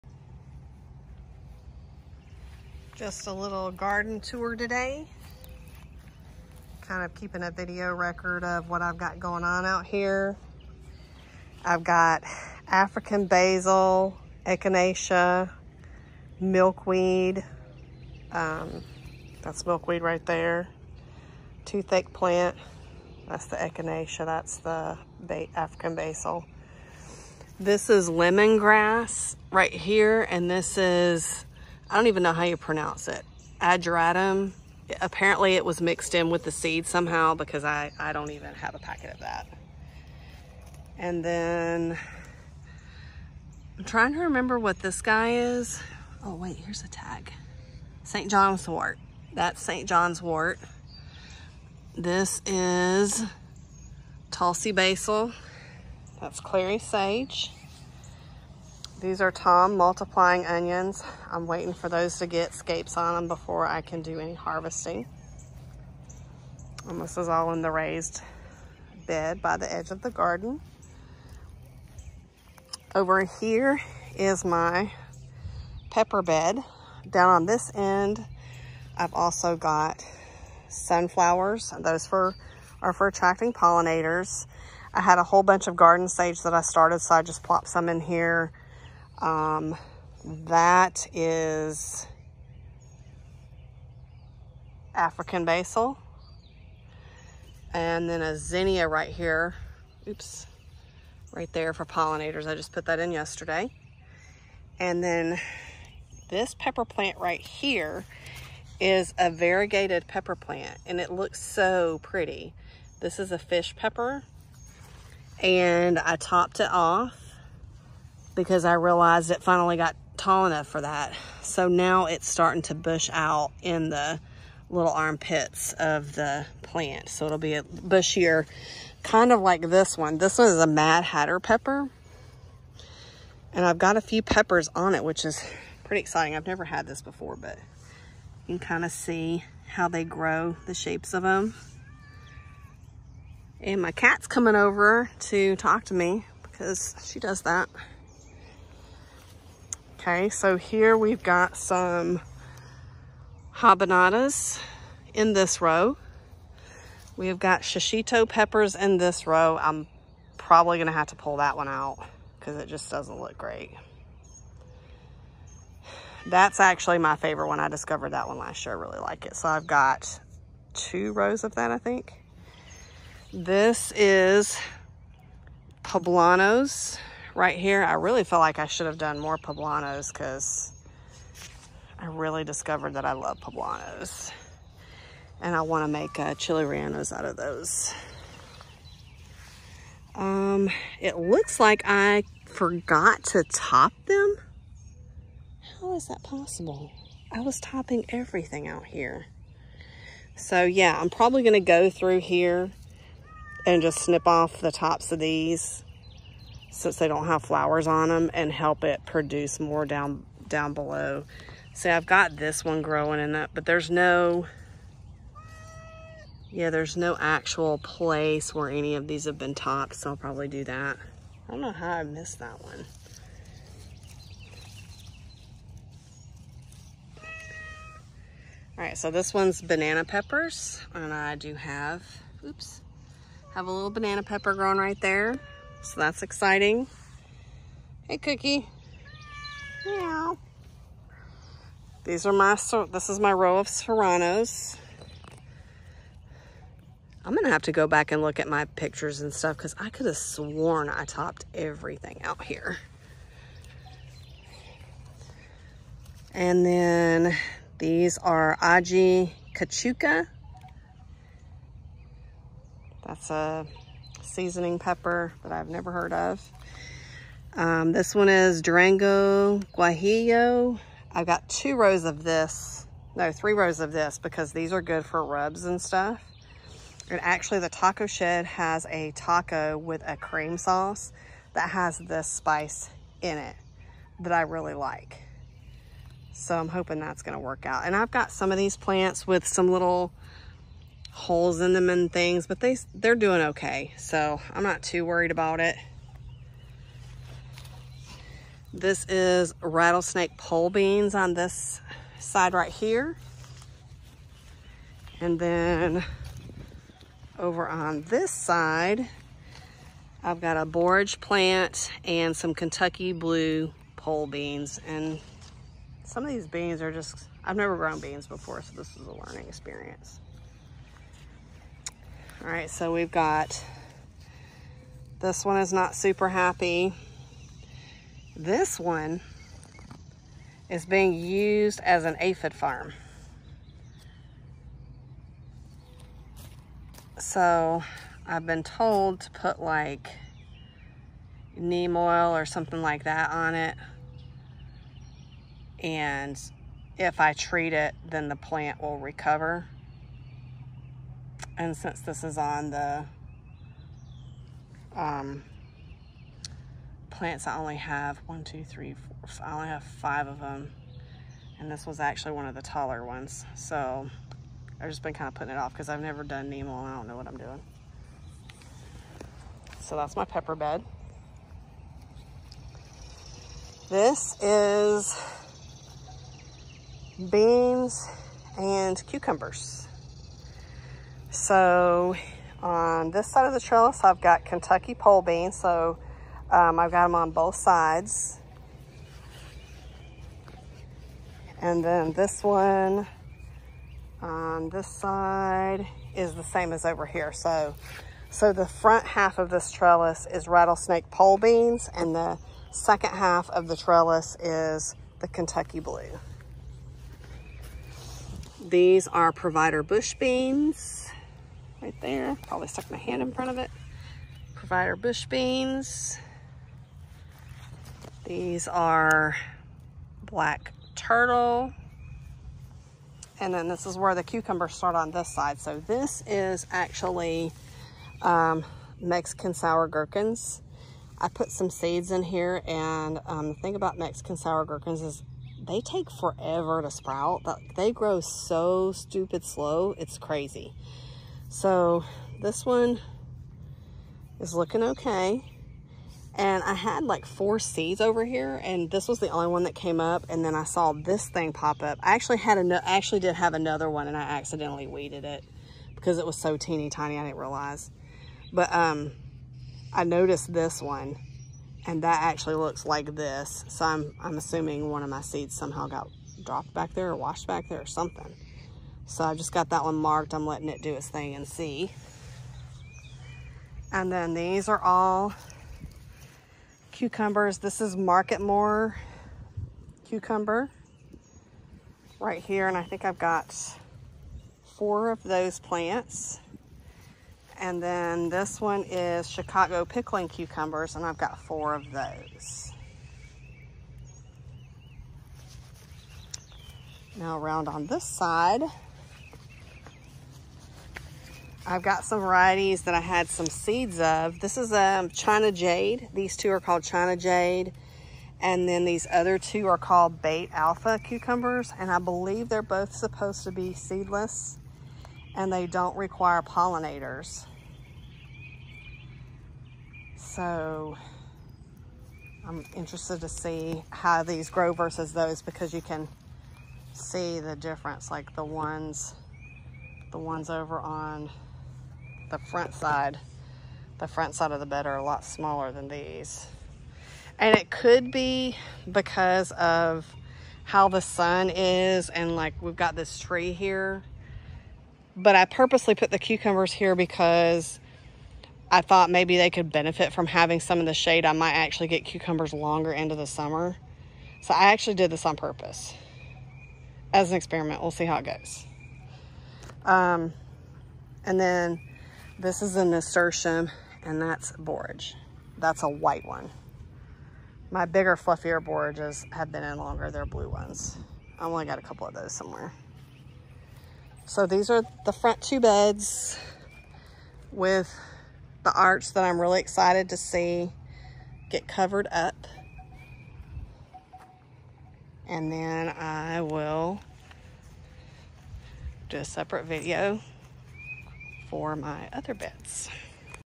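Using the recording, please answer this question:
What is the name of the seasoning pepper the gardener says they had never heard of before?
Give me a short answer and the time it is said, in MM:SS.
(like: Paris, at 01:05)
Aji Cachucha, at 04:18.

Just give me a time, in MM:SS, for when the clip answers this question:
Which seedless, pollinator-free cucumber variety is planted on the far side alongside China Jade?
08:30.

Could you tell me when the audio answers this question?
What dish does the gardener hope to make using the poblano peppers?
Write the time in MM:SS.
03:06.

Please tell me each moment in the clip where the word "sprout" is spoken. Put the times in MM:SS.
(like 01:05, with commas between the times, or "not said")
07:16.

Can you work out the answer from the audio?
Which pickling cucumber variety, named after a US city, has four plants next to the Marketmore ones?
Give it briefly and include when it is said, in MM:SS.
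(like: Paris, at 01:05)
Chicago pickling, at 08:09.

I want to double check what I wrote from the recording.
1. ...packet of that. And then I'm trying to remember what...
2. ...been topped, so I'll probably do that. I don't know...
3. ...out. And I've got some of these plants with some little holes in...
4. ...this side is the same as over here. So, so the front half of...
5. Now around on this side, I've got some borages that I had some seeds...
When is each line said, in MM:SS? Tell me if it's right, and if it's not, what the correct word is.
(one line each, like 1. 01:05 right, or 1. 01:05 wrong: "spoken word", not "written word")
1. 00:38 right
2. 03:39 right
3. 04:47 right
4. 06:34 right
5. 08:17 wrong: "varieties", not "borages".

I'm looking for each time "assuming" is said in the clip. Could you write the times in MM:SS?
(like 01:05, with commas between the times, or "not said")
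07:44.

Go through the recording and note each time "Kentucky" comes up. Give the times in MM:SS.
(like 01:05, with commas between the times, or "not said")
05:12, 06:24, 06:45.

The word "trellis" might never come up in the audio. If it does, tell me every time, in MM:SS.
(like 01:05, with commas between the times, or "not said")
06:23, 06:39, 06:43.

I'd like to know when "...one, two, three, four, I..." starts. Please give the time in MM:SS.
05:58.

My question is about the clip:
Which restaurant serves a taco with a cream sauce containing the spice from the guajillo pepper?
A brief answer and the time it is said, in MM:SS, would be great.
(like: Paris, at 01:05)
The Taco Shed, at 04:37.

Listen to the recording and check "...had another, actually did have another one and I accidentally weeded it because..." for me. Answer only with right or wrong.
right.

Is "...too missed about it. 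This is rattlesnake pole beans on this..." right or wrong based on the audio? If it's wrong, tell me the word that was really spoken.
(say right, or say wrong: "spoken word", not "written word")
wrong: "worried", not "missed".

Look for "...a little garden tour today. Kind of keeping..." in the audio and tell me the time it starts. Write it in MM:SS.
00:03.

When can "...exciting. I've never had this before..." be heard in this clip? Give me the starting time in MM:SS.
02:15.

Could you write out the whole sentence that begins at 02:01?
So now it's starting to bush out in the little armpits of the plant.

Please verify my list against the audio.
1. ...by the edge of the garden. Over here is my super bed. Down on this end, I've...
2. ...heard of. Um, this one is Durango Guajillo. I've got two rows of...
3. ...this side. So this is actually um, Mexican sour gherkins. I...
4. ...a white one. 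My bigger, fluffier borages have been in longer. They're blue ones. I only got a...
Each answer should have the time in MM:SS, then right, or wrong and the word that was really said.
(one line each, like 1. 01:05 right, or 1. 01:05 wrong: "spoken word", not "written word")
1. 01:09 wrong: "pepper", not "super"
2. 04:25 right
3. 07:05 right
4. 09:25 right.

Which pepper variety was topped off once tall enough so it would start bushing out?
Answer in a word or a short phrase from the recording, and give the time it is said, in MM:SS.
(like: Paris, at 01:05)
Fish pepper, at 01:53.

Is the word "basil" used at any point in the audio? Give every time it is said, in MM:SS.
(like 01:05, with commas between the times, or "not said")
00:13, 00:25, 00:54, 01:35.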